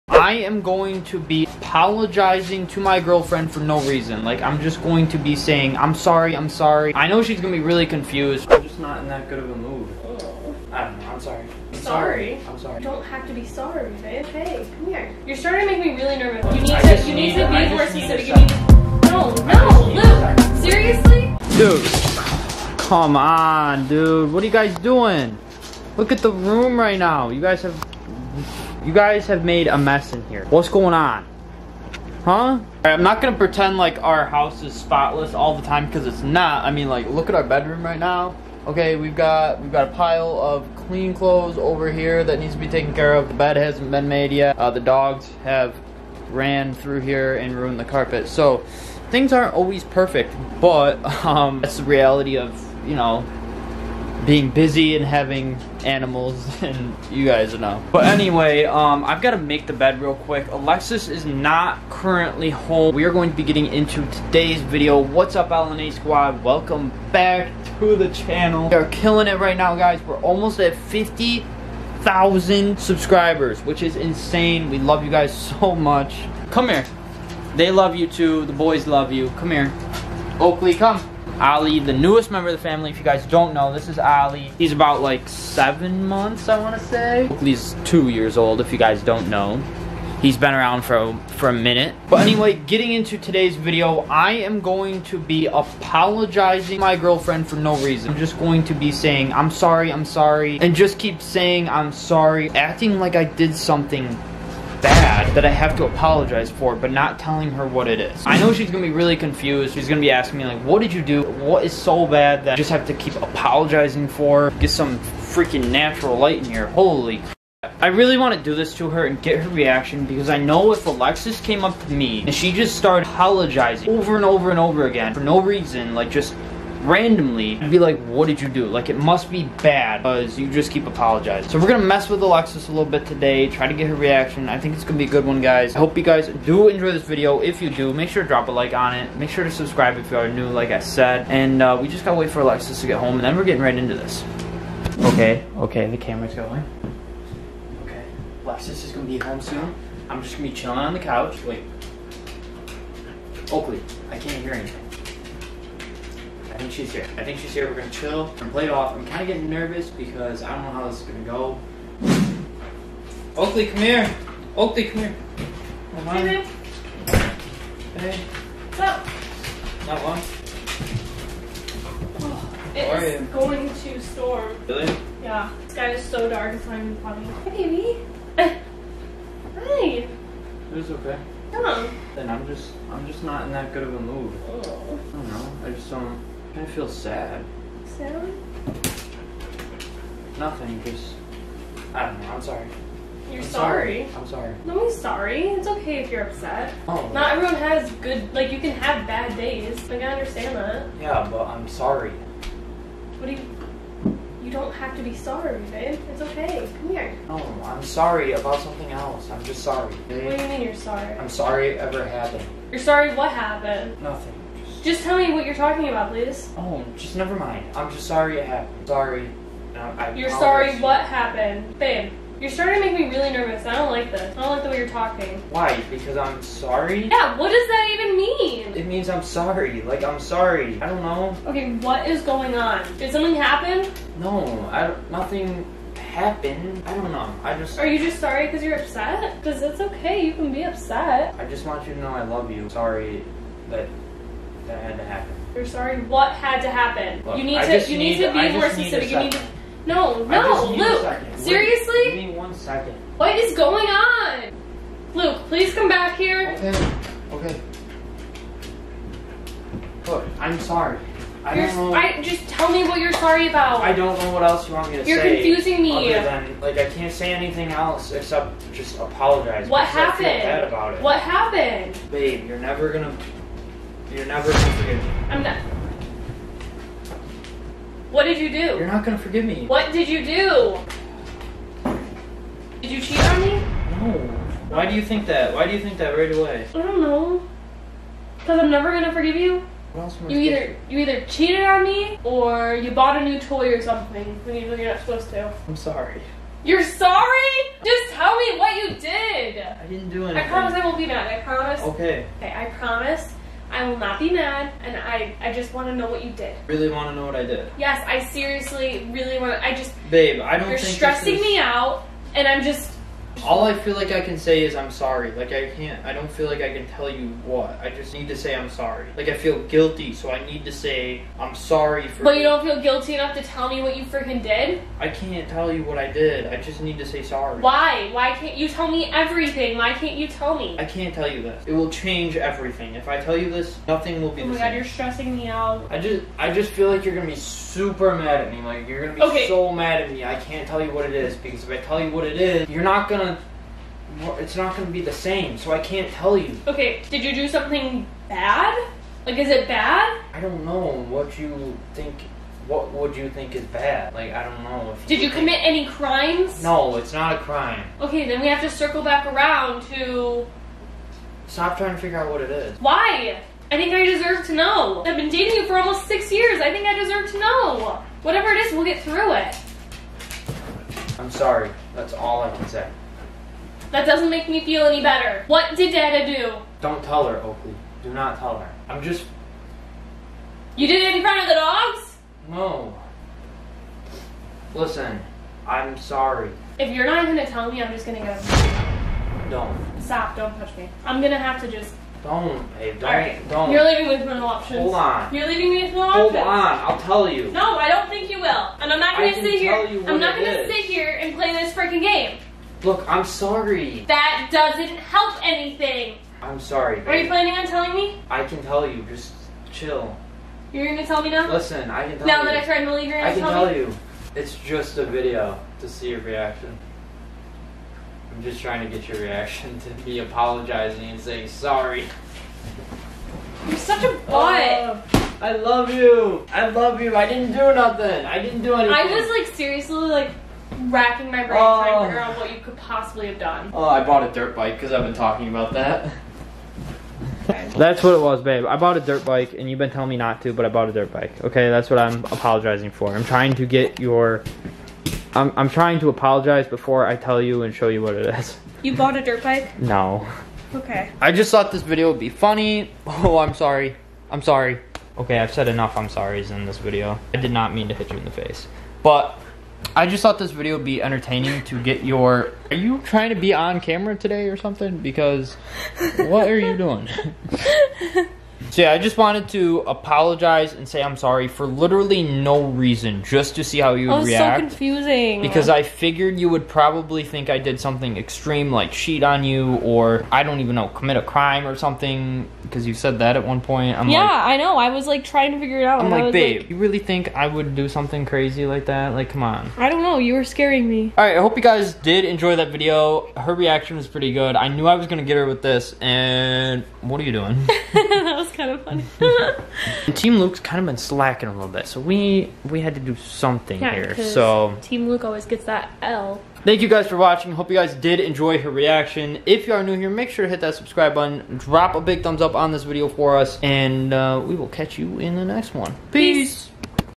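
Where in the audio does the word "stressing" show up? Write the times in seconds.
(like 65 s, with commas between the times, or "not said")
310 s, 334 s.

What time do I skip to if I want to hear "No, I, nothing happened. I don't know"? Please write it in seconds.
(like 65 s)
234 s.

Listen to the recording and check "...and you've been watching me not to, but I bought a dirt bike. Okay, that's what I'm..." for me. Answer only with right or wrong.
wrong.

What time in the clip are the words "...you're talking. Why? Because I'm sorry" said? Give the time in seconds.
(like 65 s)
224 s.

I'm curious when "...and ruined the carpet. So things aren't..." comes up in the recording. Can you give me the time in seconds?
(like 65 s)
47 s.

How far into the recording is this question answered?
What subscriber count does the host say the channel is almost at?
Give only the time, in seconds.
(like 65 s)
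70 s.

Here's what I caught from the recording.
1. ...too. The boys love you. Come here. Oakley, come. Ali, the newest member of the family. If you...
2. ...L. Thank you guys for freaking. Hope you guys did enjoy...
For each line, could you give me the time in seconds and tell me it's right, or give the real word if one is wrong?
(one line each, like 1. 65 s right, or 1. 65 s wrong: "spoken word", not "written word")
1. 78 s right
2. 506 s wrong: "watching", not "freaking".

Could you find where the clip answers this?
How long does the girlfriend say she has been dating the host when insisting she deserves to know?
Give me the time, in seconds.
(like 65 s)
365 s.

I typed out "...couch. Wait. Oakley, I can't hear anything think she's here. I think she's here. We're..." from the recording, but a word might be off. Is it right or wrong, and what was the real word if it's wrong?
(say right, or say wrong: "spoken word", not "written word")
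right.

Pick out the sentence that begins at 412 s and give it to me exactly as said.
Now that I tried to leave, you're gonna I can tell, tell you.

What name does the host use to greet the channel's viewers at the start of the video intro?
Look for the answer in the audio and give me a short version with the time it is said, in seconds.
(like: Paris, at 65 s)
L&A squad, at 65 s.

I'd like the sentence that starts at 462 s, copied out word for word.
Are you trying to be on camera today or something?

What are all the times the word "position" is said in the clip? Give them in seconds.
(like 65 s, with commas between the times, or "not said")
not said.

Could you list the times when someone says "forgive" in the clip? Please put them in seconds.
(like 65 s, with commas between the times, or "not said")
274 s, 279 s, 289 s.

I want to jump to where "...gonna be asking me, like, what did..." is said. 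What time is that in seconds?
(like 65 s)
109 s.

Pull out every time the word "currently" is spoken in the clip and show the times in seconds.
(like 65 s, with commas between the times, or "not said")
61 s.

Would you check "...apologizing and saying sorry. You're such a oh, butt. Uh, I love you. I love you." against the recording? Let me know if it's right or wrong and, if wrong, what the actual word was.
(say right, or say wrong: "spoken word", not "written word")
right.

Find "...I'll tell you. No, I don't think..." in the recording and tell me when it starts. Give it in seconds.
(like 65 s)
396 s.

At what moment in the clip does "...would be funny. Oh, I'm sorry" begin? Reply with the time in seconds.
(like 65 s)
452 s.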